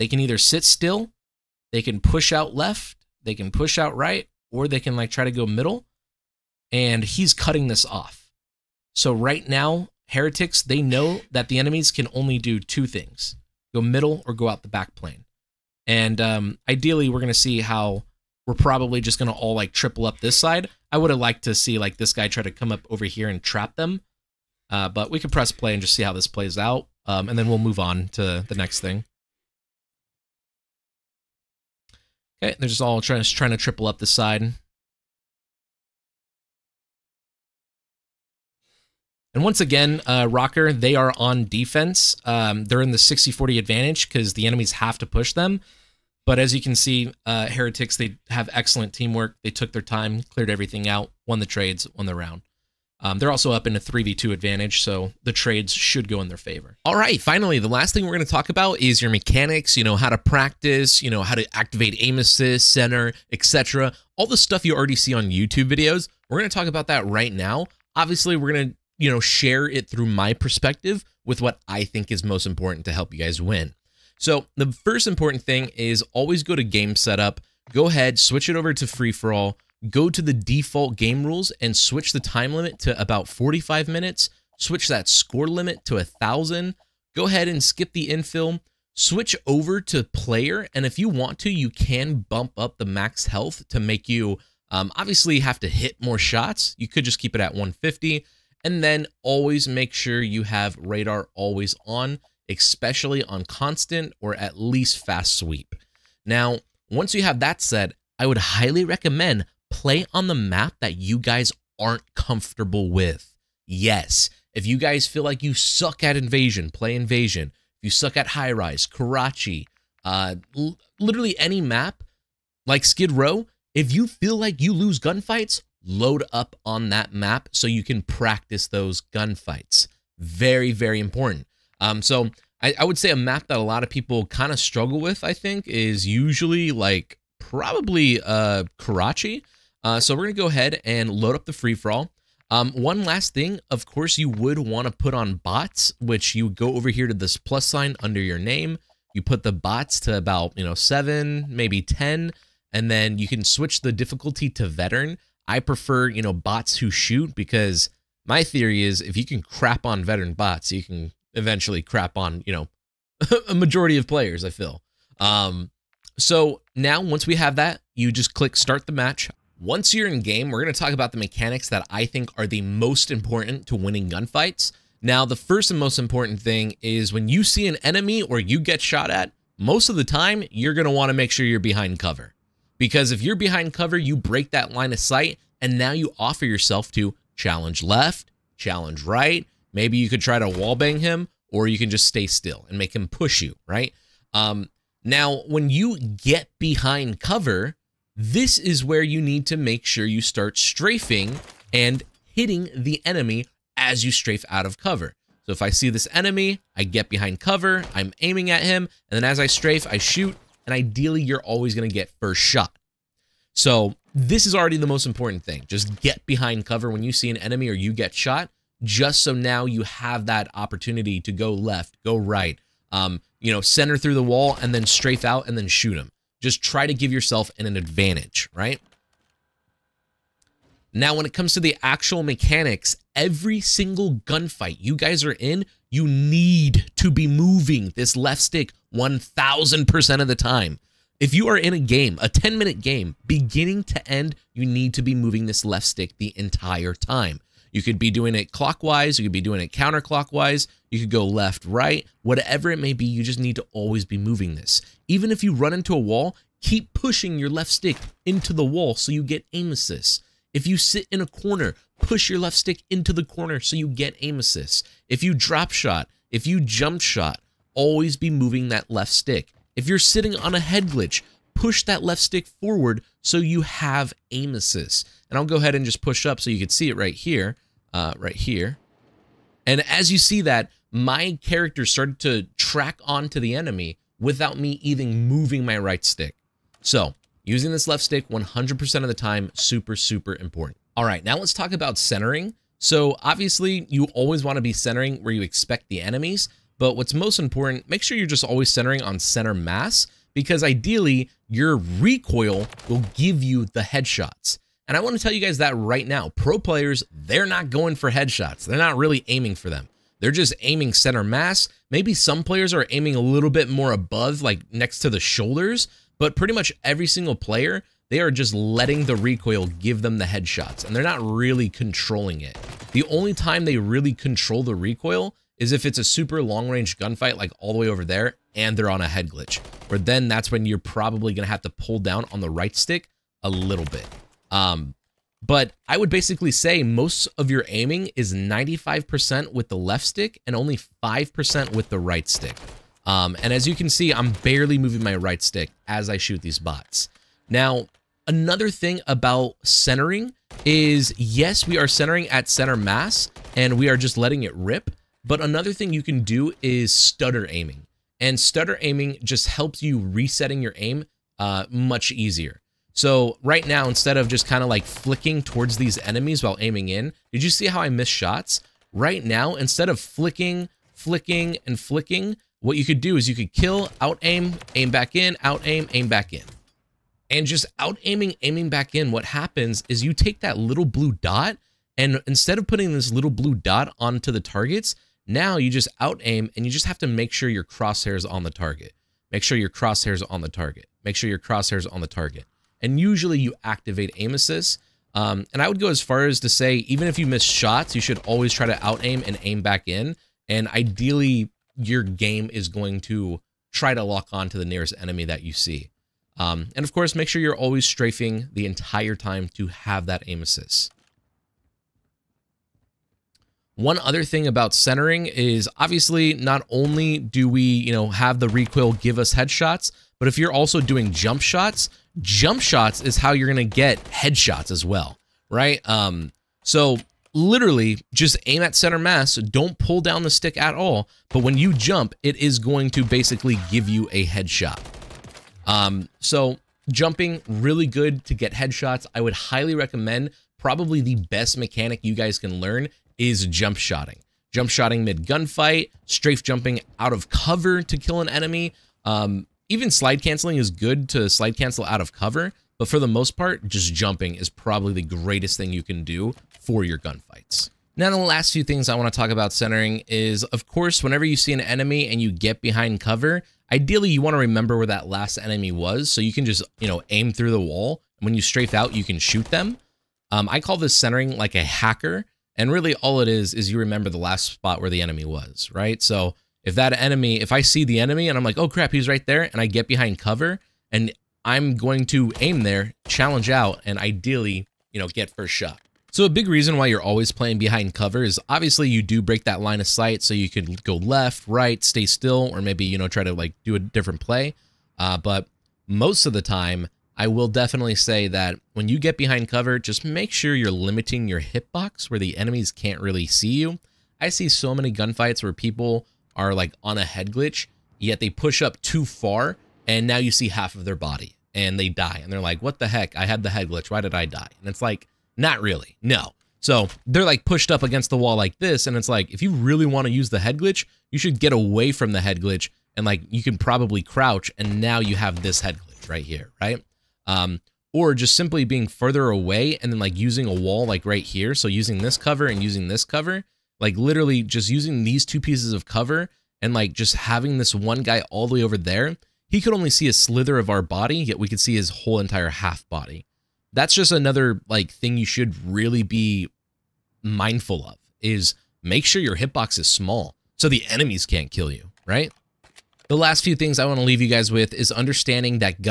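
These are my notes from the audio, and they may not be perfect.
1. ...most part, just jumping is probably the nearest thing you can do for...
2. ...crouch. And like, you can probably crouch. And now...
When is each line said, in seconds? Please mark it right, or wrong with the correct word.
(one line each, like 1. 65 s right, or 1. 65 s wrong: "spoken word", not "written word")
1. 453 s wrong: "greatest", not "nearest"
2. 522 s wrong: "glitch", not "crouch".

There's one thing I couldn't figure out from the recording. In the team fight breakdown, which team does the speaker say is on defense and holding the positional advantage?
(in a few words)
ROKKR.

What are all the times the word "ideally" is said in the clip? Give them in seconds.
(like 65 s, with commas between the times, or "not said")
16 s, 210 s, 300 s, 400 s, 463 s, 483 s.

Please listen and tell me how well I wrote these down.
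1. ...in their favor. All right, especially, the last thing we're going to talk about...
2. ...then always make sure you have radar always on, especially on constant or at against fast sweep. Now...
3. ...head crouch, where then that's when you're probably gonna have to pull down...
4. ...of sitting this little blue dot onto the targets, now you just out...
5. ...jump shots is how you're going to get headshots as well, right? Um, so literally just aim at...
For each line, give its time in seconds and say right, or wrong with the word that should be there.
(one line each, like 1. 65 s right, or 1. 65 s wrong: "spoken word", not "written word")
1. 56 s wrong: "finally", not "especially"
2. 98 s wrong: "least", not "against"
3. 329 s wrong: "glitch", not "crouch"
4. 382 s wrong: "putting", not "sitting"
5. 422 s right.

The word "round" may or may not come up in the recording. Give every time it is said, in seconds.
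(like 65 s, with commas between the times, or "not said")
52 s.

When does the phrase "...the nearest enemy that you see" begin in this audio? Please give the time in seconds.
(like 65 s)
404 s.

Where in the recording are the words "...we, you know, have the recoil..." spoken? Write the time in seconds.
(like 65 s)
417 s.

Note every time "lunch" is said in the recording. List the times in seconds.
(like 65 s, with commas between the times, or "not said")
not said.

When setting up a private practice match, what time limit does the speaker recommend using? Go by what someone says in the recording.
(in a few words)
45 minutes.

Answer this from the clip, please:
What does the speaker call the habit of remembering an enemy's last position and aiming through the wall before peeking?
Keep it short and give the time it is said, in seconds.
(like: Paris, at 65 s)
centering like a hacker, at 470 s.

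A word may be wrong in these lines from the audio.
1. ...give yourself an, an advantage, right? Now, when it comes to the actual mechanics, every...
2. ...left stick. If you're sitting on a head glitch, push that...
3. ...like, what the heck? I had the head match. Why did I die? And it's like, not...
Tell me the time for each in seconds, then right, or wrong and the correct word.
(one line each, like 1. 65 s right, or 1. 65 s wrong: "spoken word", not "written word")
1. 226 s right
2. 268 s right
3. 512 s wrong: "glitch", not "match".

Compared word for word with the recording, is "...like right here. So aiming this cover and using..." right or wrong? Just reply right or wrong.
wrong.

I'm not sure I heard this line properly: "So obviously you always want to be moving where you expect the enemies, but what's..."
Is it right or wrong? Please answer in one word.
wrong.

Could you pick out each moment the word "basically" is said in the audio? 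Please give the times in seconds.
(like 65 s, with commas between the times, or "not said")
336 s, 433 s.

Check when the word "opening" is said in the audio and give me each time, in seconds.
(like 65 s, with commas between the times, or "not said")
not said.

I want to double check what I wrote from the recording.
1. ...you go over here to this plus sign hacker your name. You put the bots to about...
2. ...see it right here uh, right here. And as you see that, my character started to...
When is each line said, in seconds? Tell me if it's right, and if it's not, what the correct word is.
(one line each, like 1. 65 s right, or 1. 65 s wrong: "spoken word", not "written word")
1. 146 s wrong: "under", not "hacker"
2. 276 s right.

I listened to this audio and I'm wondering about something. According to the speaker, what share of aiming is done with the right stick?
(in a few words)
5%.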